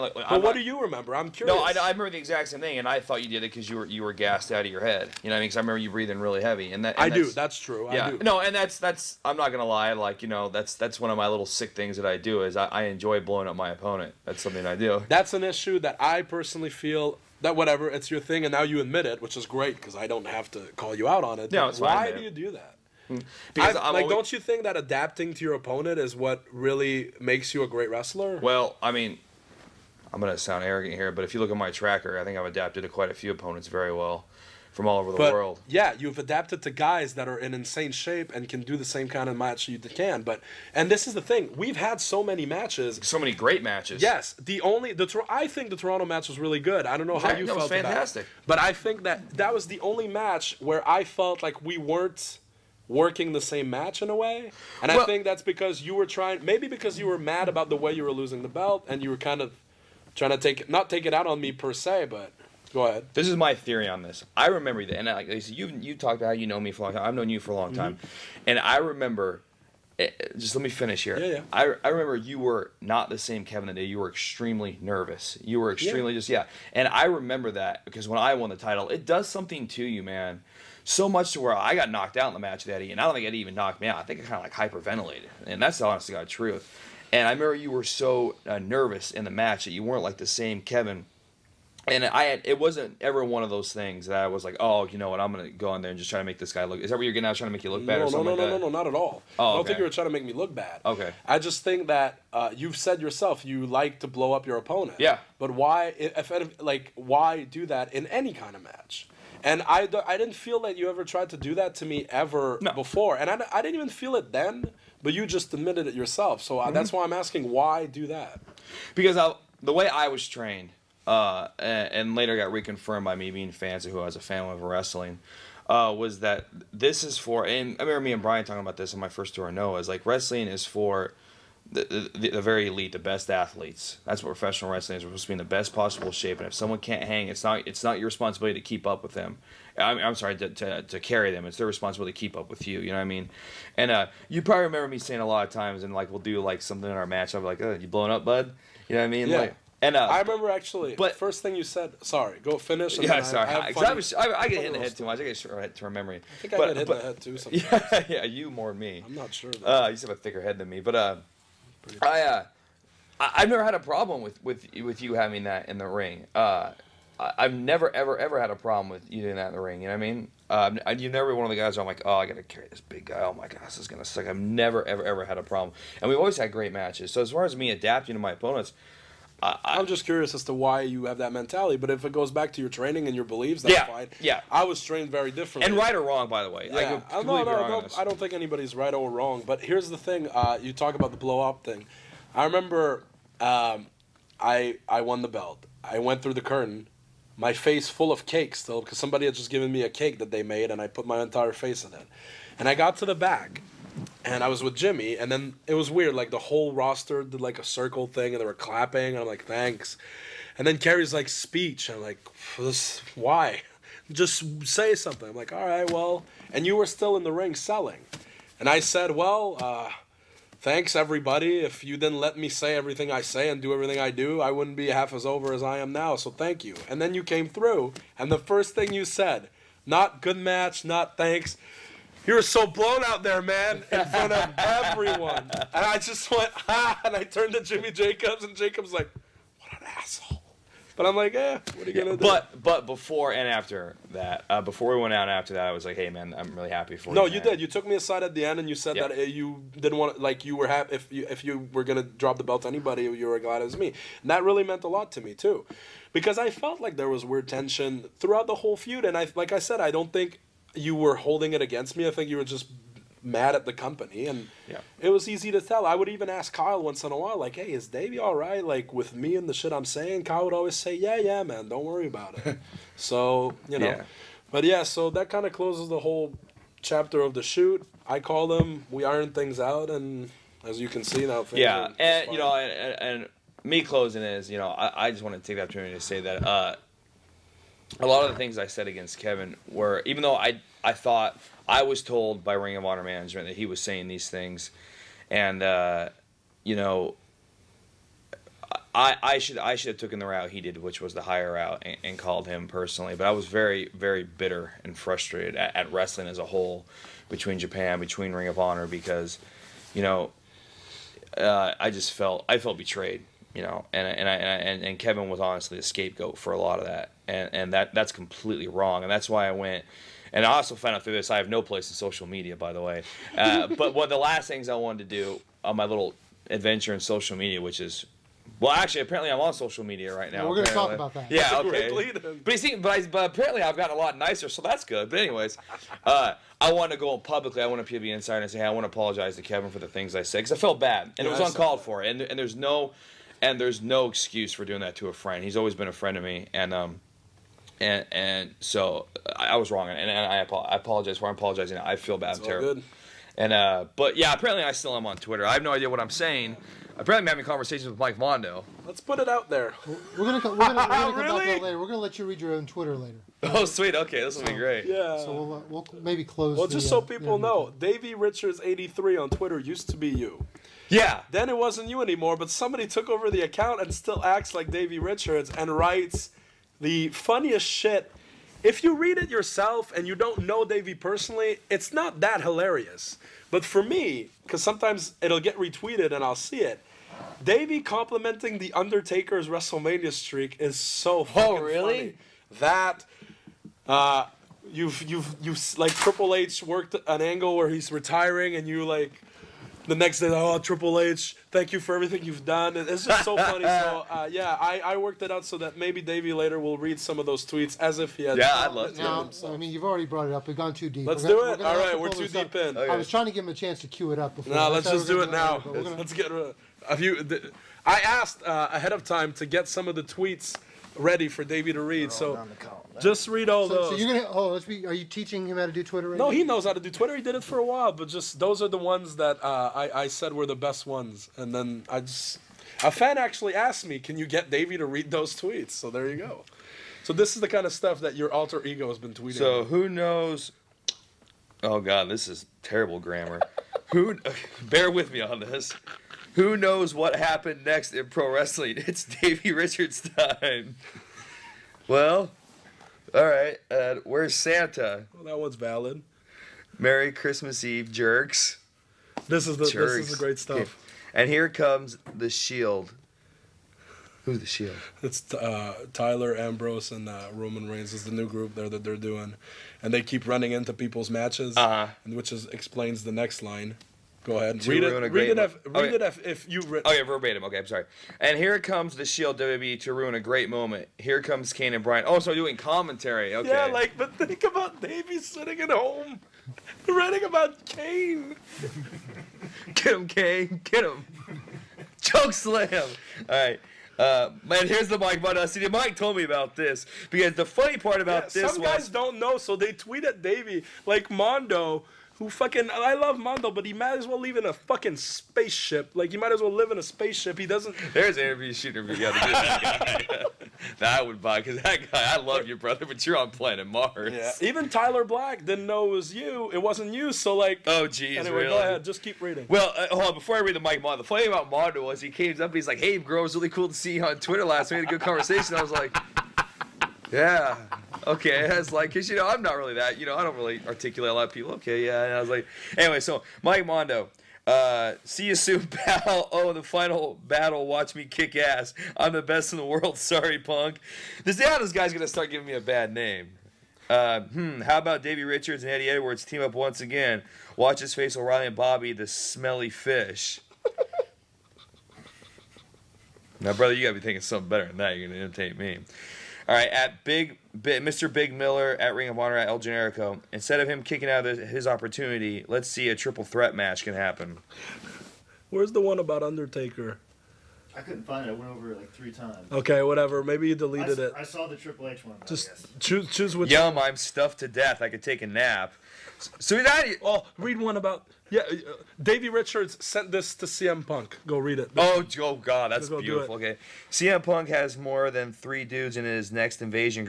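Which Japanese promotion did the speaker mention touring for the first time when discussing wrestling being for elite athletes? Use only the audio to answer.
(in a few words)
Noah.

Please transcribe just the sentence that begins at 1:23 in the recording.
I think I kind of like hyperventilated, and that's the honest to God truth.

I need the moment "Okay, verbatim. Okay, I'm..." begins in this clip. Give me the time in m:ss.
7:56.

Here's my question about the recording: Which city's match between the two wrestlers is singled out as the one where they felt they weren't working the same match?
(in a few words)
Toronto.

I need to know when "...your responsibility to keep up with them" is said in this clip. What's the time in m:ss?
2:17.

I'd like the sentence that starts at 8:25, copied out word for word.
Like he might as well live in a spaceship.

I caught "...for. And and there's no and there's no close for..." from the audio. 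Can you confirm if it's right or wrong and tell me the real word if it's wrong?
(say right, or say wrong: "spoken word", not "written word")
wrong: "excuse", not "close".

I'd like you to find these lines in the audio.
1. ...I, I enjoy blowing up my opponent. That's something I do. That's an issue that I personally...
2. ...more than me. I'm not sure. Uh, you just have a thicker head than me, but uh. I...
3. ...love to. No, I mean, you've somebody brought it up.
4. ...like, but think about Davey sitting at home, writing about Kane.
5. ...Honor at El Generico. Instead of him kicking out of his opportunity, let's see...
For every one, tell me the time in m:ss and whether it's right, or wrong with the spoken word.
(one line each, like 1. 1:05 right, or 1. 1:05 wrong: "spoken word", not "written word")
1. 0:12 right
2. 2:38 right
3. 6:48 wrong: "already", not "somebody"
4. 8:03 right
5. 9:19 right.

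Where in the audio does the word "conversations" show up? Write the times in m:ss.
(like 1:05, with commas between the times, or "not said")
5:57, 8:45.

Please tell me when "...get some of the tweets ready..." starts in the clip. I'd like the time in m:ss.
6:59.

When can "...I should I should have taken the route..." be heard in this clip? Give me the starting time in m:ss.
4:59.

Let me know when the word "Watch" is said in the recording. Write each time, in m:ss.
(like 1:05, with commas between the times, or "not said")
8:57, 9:07.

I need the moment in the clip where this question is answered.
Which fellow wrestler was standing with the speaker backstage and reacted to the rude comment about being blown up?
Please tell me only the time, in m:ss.
3:57.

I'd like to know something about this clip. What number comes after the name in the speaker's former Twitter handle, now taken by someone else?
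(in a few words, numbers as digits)
83.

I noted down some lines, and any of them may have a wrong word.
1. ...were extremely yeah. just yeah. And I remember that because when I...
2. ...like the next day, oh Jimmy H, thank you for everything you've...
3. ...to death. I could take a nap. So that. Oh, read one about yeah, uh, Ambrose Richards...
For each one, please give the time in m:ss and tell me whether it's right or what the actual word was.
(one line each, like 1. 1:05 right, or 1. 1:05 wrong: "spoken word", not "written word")
1. 1:15 right
2. 6:38 wrong: "Triple", not "Jimmy"
3. 9:34 wrong: "Davey", not "Ambrose".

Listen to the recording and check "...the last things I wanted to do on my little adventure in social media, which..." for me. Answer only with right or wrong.
right.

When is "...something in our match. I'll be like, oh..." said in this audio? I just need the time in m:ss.
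2:26.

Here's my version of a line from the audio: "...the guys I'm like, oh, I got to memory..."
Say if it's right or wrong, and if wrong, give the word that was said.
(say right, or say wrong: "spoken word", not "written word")
wrong: "carry", not "memory".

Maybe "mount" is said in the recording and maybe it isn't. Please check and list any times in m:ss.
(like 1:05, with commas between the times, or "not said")
not said.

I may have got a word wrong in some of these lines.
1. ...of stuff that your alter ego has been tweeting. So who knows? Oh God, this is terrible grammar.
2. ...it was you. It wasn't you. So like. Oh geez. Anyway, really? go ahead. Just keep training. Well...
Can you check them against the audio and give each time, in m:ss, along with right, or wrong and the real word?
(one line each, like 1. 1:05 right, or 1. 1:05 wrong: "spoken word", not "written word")
1. 7:17 right
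2. 8:35 wrong: "reading", not "training".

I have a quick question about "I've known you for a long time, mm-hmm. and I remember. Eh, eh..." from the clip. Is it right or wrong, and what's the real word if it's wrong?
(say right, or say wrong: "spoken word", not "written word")
right.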